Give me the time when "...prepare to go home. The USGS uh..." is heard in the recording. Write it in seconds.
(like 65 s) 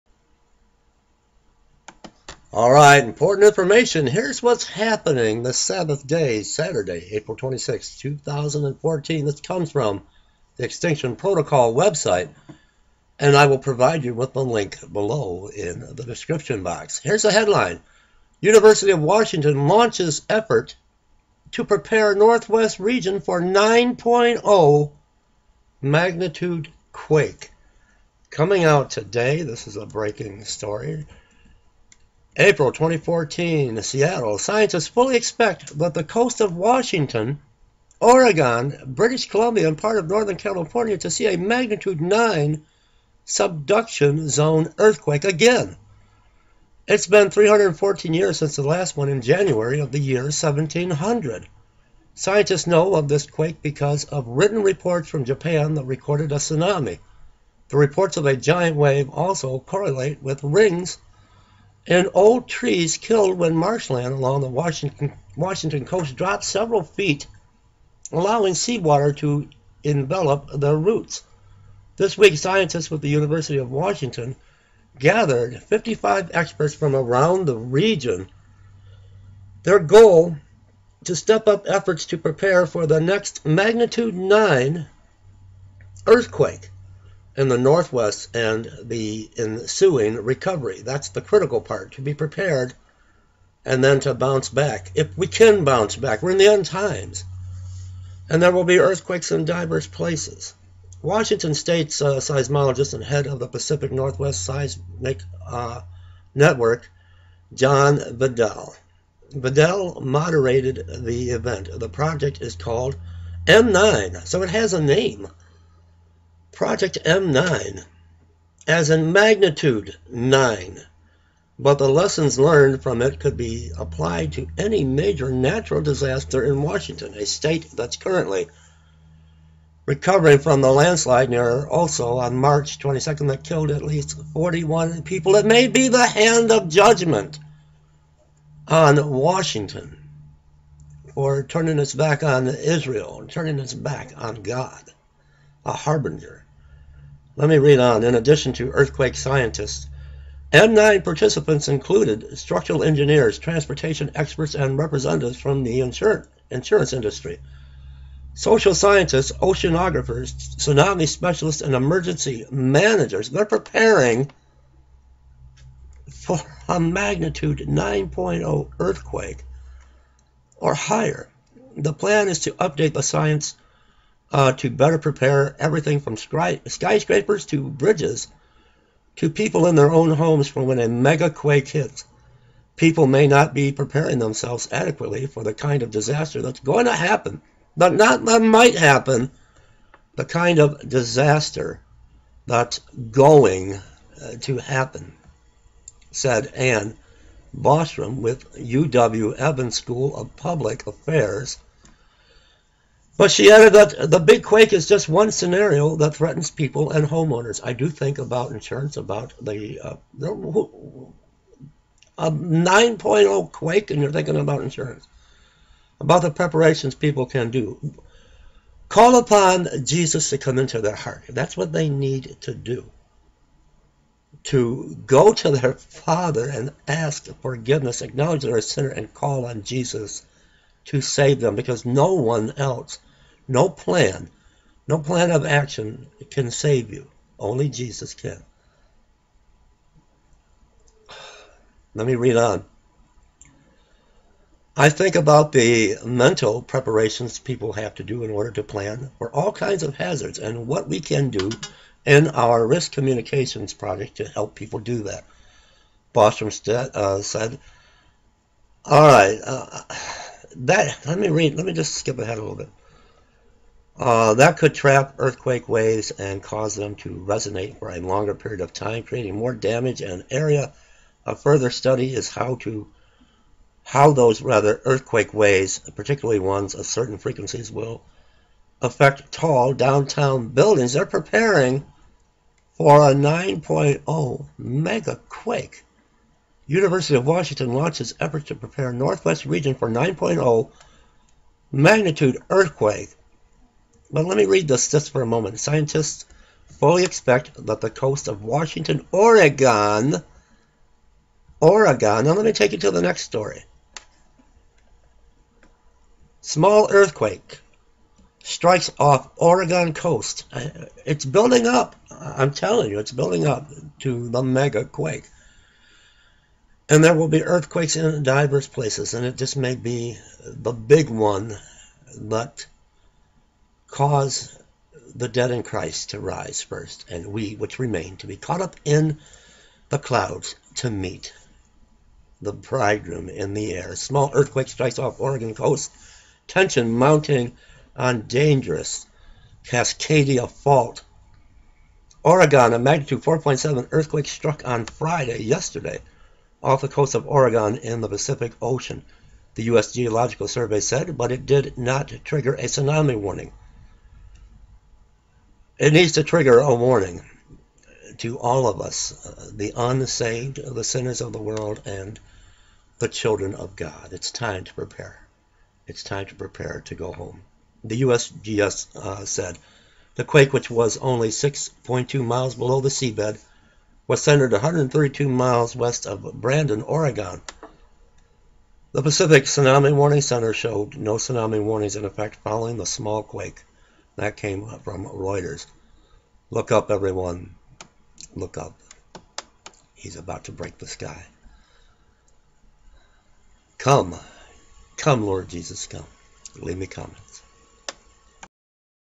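366 s.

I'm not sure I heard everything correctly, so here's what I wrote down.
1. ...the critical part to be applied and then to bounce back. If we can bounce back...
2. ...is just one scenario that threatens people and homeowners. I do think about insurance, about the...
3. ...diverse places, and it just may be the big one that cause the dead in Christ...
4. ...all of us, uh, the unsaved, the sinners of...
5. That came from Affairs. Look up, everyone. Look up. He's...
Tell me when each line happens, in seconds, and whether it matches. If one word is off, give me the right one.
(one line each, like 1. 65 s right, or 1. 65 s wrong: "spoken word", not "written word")
1. 91 s wrong: "prepared", not "applied"
2. 204 s right
3. 318 s right
4. 358 s right
5. 384 s wrong: "Reuters", not "Affairs".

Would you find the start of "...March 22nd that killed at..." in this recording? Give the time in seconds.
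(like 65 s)
132 s.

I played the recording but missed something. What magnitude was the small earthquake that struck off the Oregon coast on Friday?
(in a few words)
4.7.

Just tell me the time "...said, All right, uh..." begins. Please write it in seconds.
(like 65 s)
257 s.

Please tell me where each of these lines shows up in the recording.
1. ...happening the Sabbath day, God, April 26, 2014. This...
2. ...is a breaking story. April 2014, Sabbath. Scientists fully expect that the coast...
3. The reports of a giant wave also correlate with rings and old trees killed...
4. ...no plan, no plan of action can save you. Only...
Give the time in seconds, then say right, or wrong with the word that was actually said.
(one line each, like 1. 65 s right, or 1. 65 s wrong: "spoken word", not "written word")
1. 4 s wrong: "Saturday", not "God"
2. 29 s wrong: "Seattle", not "Sabbath"
3. 57 s right
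4. 233 s right.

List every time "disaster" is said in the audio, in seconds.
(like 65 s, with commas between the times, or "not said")
125 s, 185 s, 190 s.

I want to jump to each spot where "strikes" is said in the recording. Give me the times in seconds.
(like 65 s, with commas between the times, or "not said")
308 s, 334 s.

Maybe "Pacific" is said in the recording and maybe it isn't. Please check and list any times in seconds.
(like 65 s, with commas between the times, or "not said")
103 s, 348 s, 379 s.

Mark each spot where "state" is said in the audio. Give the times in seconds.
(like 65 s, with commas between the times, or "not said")
101 s, 127 s.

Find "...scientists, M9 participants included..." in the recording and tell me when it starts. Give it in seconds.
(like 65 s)
149 s.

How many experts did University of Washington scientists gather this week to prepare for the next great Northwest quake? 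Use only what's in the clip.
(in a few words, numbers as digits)
55.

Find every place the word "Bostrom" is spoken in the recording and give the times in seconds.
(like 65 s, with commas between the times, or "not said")
197 s, 256 s.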